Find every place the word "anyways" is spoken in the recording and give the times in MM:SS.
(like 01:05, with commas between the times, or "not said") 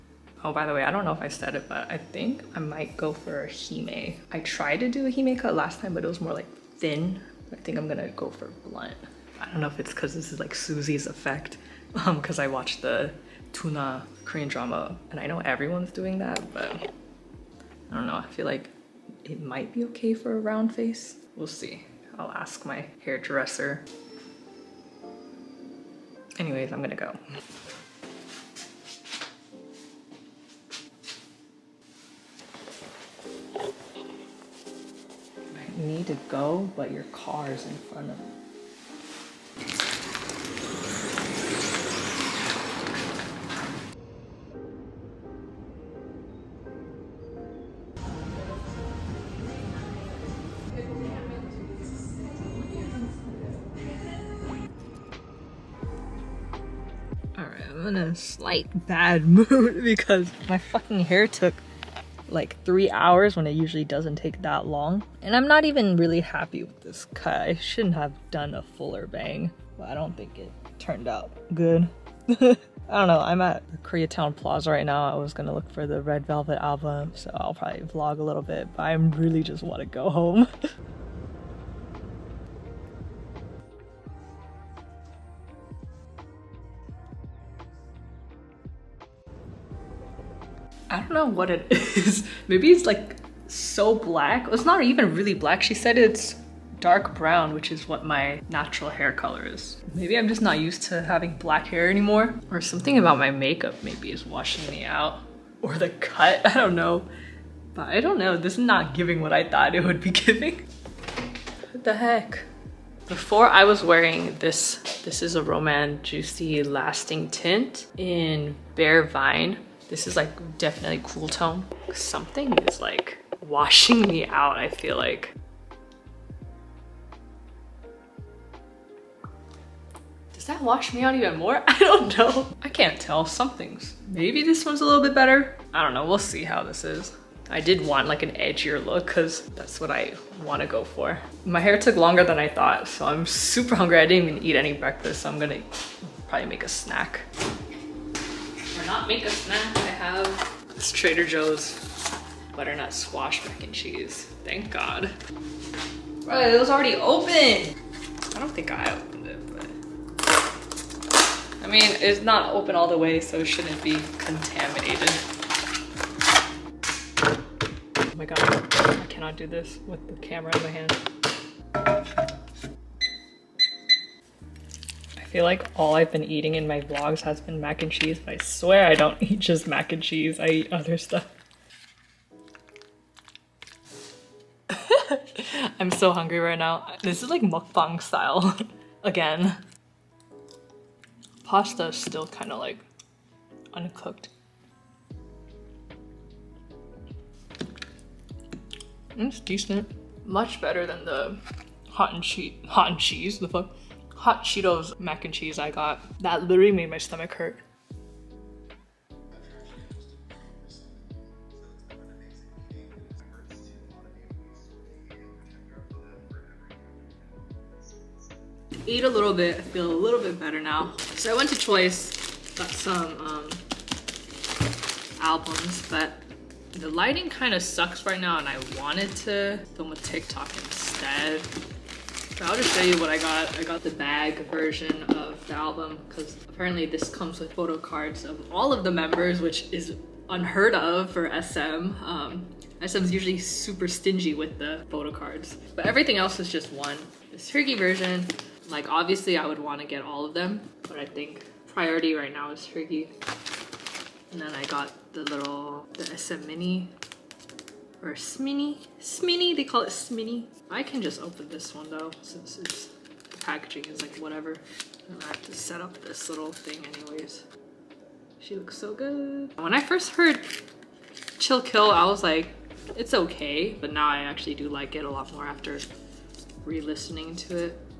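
00:26, 04:26.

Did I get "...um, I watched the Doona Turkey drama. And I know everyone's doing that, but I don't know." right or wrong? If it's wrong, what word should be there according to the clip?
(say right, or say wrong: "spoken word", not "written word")
wrong: "Korean", not "Turkey".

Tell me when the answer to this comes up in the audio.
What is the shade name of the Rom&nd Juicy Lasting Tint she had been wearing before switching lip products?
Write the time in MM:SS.
01:58.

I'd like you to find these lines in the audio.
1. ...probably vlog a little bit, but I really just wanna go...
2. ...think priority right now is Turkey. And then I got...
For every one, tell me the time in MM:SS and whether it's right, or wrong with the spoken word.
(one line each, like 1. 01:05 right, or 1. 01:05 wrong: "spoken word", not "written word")
1. 01:17 right
2. 04:11 right.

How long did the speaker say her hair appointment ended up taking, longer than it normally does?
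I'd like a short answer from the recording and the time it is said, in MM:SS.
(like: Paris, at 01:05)
3 hours, at 01:02.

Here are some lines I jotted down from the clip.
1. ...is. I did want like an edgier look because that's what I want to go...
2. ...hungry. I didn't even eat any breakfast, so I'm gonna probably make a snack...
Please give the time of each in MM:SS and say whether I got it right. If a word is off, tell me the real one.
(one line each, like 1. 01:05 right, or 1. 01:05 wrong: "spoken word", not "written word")
1. 02:16 right
2. 02:23 right.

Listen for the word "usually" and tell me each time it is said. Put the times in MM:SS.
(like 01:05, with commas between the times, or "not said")
01:03, 04:03.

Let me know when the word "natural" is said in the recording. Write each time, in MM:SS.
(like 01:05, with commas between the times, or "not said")
01:38.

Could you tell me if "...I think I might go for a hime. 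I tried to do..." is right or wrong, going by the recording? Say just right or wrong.
right.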